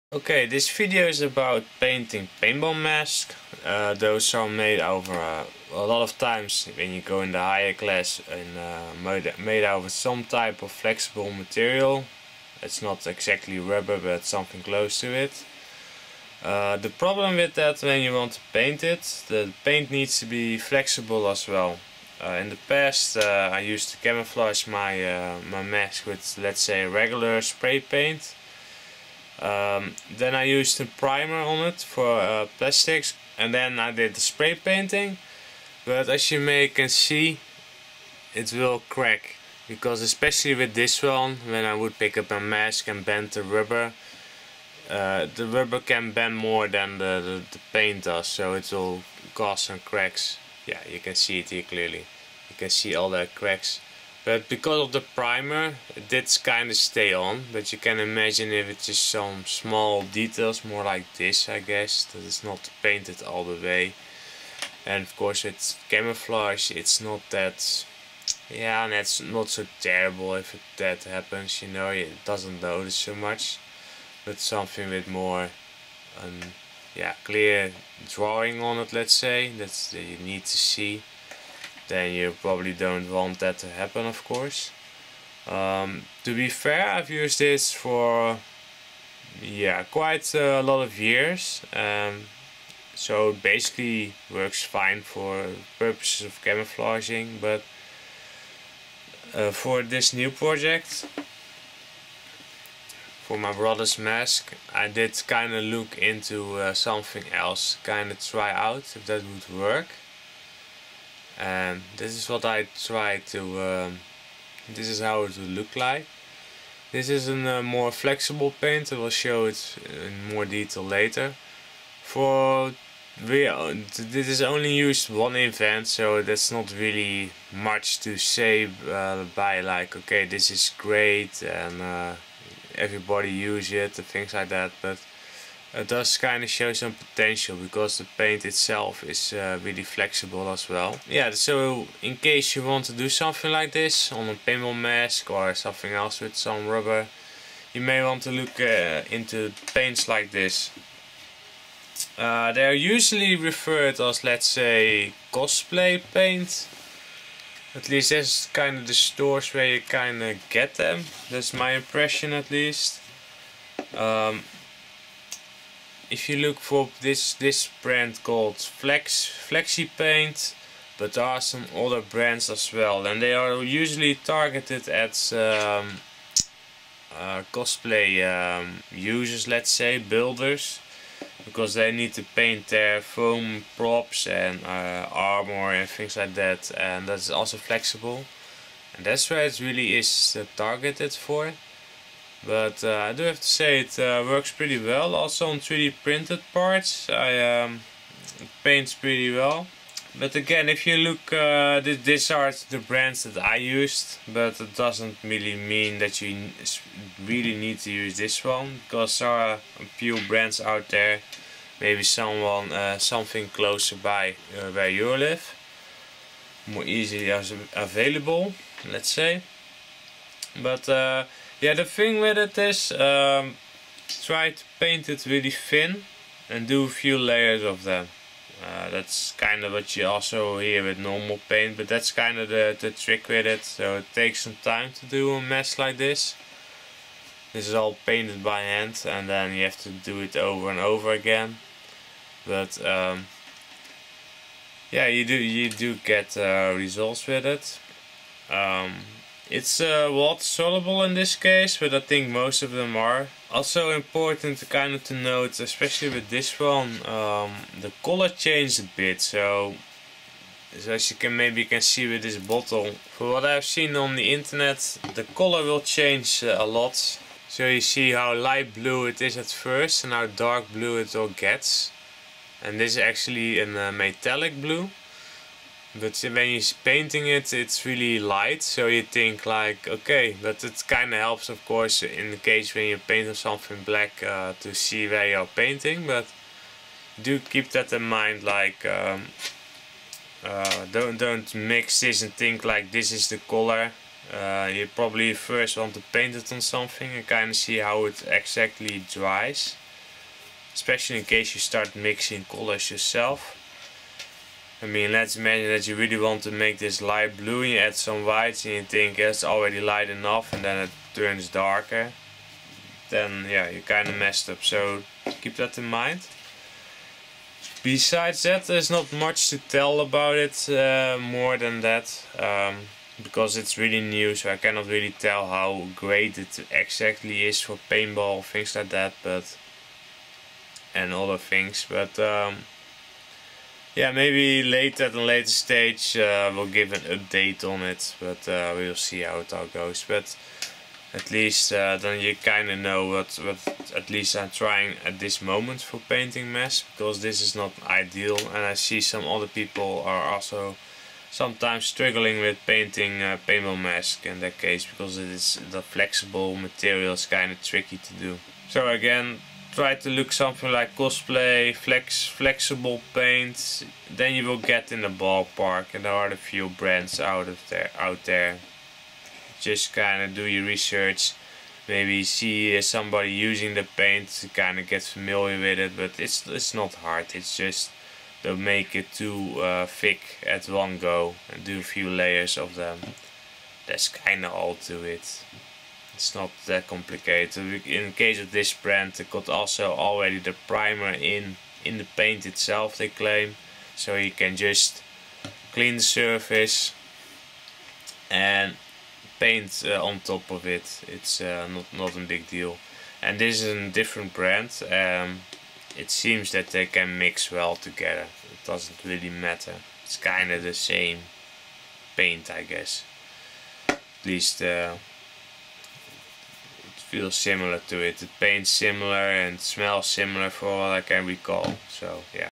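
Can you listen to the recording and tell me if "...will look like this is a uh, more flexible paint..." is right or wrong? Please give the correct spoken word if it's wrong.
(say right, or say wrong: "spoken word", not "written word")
right.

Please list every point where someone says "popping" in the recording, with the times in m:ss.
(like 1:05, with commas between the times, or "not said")
not said.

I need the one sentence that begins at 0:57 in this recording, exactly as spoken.
But you can imagine if it's just some small details, more like this, I guess, that it's not painted all the way.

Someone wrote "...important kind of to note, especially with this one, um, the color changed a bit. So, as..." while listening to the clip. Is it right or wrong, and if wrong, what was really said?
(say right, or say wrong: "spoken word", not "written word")
right.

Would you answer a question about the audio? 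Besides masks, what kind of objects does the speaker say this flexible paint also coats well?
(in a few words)
3D printed parts.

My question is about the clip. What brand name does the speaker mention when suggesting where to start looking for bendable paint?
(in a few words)
Flexi Paint.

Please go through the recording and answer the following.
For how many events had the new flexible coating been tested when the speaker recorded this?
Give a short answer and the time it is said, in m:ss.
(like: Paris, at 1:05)
1, at 2:05.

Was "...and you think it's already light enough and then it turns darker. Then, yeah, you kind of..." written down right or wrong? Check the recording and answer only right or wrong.
right.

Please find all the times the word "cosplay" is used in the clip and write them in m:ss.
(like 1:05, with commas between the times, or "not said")
2:35, 2:57, 6:00.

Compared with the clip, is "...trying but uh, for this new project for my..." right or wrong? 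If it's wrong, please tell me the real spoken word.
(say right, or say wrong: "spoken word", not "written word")
wrong: "camouflaging", not "trying".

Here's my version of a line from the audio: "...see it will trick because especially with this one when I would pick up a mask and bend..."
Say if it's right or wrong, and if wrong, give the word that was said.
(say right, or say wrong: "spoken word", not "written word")
wrong: "crack", not "trick".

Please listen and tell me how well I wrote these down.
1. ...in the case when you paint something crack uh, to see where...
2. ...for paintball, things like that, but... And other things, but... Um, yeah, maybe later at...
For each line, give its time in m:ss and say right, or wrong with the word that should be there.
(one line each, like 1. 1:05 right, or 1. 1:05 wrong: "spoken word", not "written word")
1. 4:42 wrong: "black", not "crack"
2. 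5:27 right.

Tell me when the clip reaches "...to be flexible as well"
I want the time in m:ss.
0:20.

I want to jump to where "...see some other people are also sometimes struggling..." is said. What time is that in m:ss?
5:48.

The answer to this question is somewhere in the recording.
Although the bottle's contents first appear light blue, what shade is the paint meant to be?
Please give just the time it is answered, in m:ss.
4:33.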